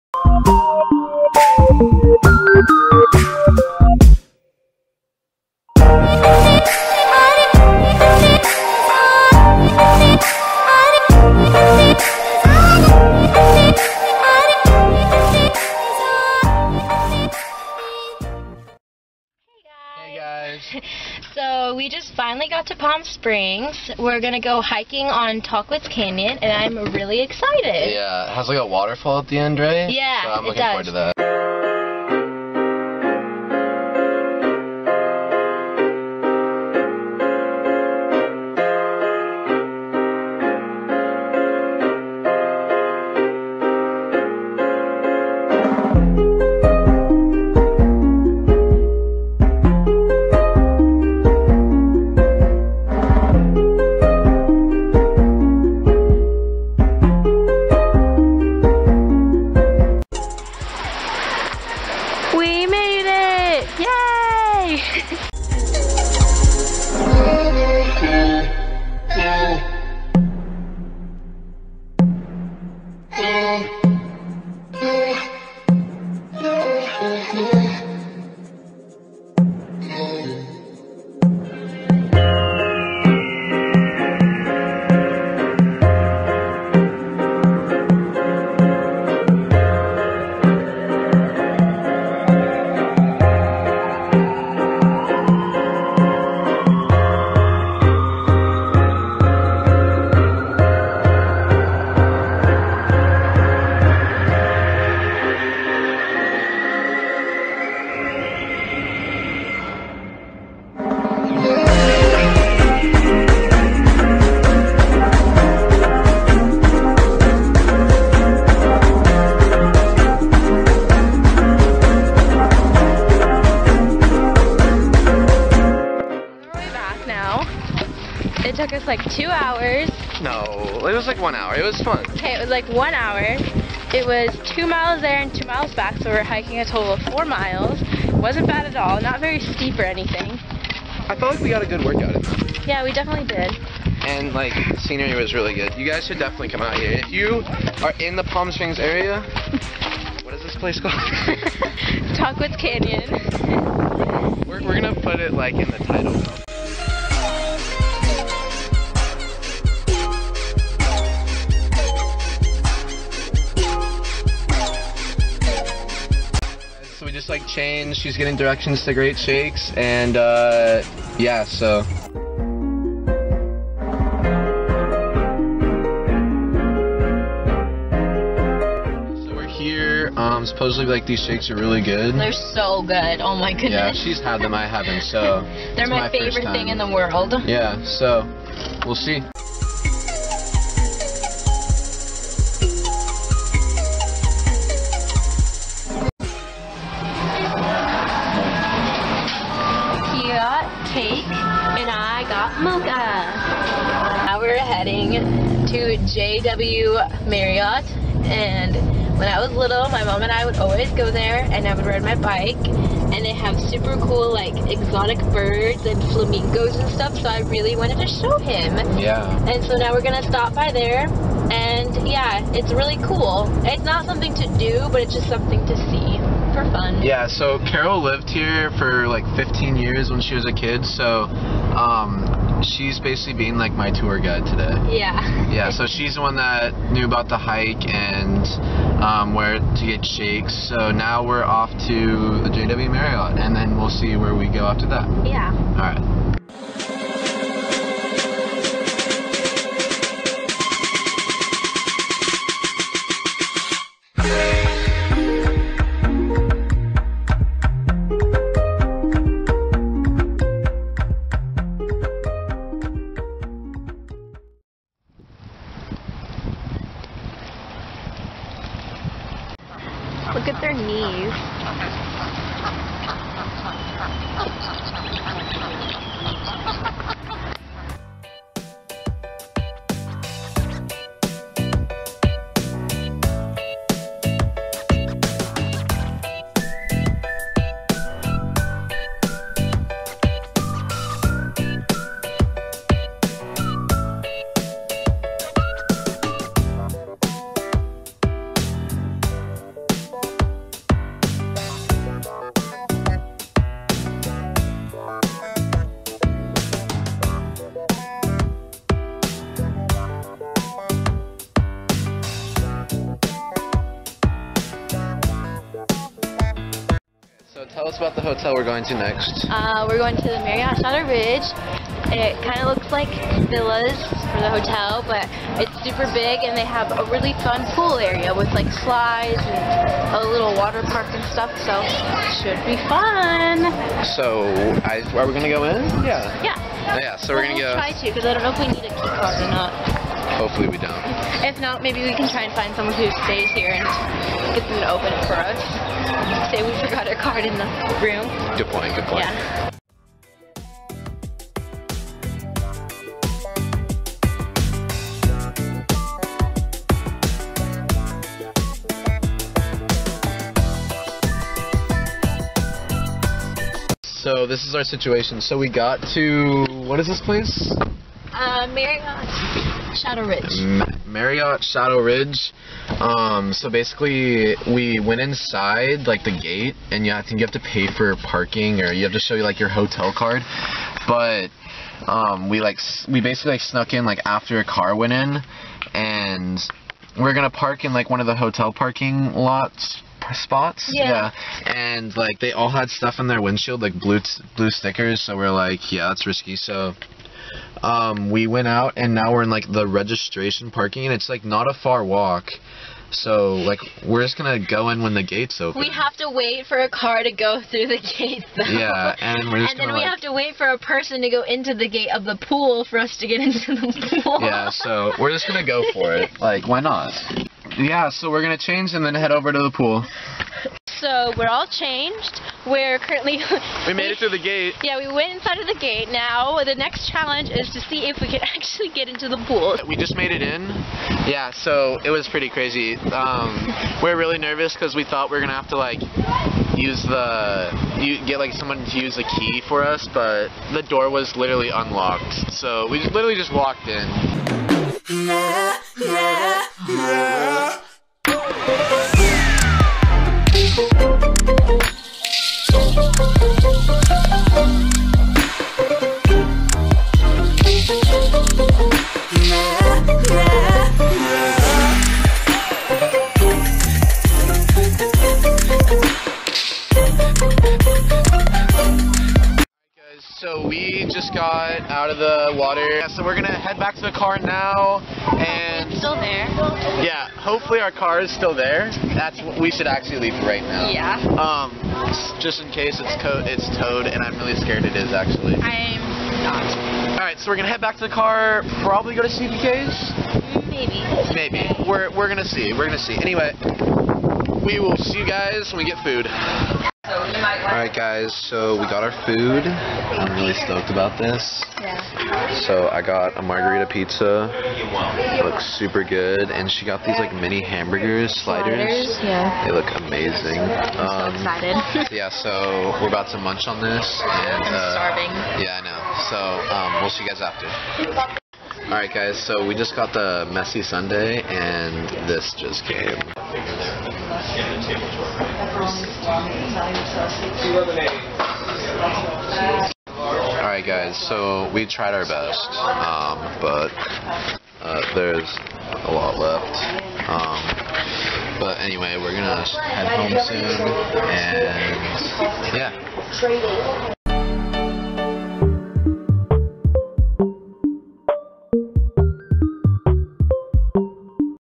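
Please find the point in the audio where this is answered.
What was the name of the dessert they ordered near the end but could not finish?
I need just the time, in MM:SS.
08:40.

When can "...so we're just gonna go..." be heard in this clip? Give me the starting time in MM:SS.
06:54.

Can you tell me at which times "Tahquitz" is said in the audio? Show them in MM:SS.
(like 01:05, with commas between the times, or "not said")
00:25, 02:32.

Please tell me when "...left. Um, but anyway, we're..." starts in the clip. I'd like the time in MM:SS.
08:56.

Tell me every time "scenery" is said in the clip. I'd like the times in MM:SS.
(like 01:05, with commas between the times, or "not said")
02:24.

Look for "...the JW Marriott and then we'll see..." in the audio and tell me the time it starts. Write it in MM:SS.
04:02.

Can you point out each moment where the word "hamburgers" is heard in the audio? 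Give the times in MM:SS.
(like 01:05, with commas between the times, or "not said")
08:27.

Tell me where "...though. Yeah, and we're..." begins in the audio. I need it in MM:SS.
06:48.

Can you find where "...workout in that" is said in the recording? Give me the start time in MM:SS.
02:21.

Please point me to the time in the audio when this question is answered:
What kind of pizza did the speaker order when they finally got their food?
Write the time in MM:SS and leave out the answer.
08:23.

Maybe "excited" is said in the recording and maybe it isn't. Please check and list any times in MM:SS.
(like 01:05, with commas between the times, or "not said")
00:27, 08:31.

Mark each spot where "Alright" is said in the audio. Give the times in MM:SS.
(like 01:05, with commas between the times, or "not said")
08:17, 08:38, 08:50.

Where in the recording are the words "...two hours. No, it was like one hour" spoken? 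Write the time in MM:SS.
02:09.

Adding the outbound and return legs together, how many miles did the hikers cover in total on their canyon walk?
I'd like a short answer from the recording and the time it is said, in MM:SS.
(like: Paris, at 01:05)
4, at 02:17.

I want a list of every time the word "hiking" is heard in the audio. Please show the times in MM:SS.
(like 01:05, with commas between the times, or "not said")
00:24, 02:16.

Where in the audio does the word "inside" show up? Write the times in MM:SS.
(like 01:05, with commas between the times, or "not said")
06:15, 07:05.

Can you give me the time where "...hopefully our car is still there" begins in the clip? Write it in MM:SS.
07:57.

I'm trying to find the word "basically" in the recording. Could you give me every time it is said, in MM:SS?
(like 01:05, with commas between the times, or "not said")
03:52, 06:13, 06:23.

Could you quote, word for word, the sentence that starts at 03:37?
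So I really wanted to show him.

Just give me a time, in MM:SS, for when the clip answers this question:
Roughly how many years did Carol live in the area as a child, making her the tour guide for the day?
03:49.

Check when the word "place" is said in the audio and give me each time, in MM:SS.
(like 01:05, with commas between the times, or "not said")
02:30, 06:07.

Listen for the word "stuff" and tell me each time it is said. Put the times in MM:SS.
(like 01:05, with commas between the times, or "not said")
03:36, 05:31, 06:32.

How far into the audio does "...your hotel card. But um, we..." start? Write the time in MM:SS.
06:19.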